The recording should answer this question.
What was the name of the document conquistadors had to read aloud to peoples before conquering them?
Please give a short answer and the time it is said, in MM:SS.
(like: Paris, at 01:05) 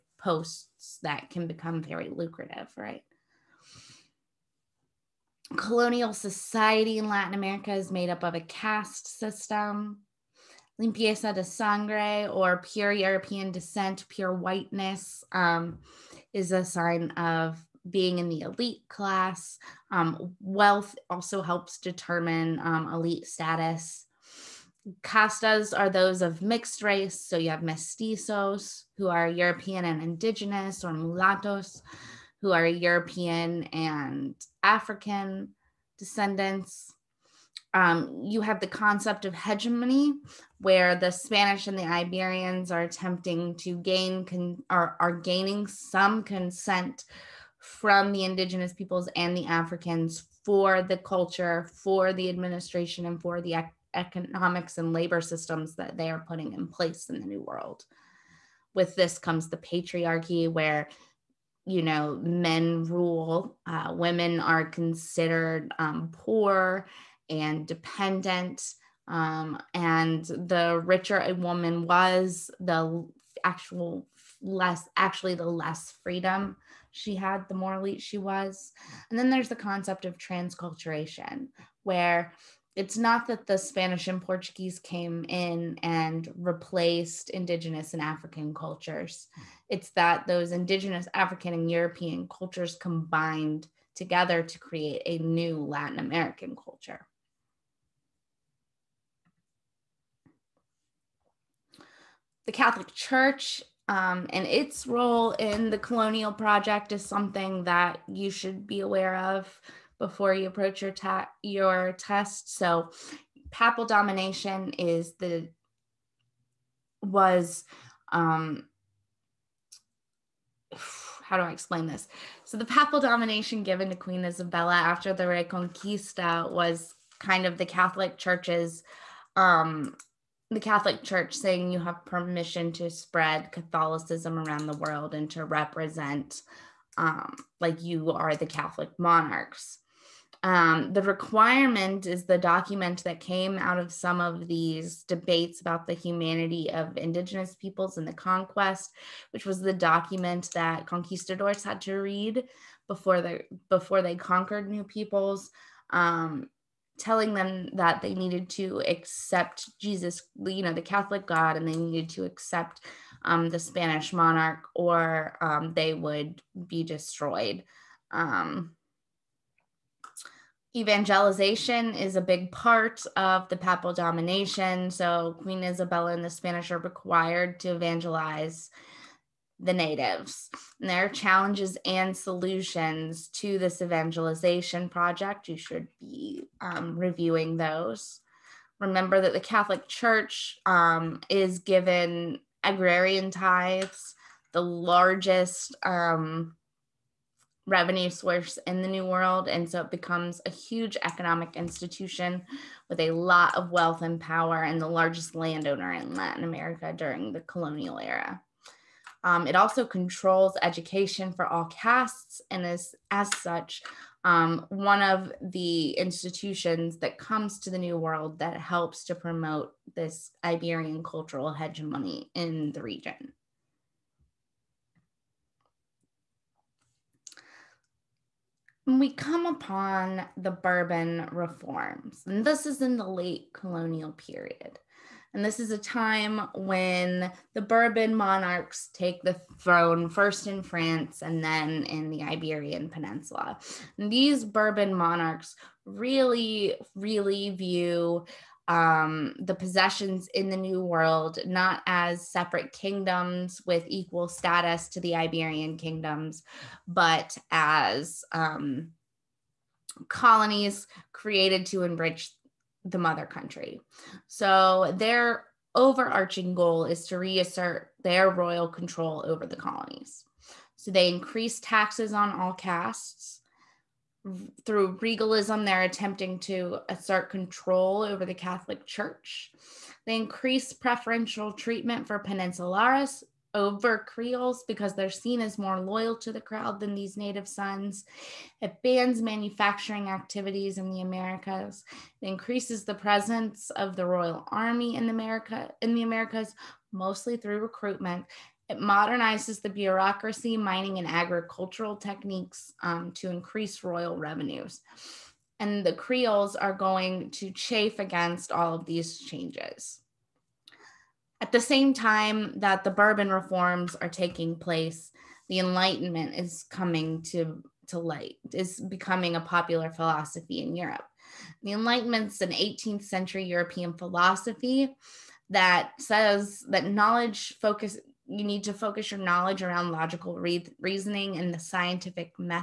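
the requirement, at 02:20.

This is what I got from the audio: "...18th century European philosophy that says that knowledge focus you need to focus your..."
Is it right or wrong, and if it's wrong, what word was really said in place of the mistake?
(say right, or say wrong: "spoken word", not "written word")
right.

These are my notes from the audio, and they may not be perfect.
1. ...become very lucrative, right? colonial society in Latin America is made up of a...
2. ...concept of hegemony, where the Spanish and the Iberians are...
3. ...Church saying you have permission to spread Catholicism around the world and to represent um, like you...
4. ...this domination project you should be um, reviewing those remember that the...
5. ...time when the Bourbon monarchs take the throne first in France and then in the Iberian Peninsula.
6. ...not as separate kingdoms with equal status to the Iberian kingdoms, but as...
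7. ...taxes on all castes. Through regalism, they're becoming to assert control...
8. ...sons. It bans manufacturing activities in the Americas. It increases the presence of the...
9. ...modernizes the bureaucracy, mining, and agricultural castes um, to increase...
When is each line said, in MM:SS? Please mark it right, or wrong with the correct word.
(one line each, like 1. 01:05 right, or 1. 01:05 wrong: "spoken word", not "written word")
1. 00:01 right
2. 00:38 right
3. 02:11 right
4. 03:03 wrong: "evangelization", not "domination"
5. 03:55 right
6. 04:11 right
7. 04:31 wrong: "attempting", not "becoming"
8. 04:47 right
9. 04:58 wrong: "techniques", not "castes".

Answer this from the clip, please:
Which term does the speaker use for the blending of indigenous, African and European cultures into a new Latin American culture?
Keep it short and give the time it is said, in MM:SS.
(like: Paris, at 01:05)
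transculturation, at 01:20.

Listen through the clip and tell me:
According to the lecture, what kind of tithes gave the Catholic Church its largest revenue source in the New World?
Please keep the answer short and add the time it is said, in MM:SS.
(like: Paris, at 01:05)
agrarian tithes, at 03:12.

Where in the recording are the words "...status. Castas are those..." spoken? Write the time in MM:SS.
00:23.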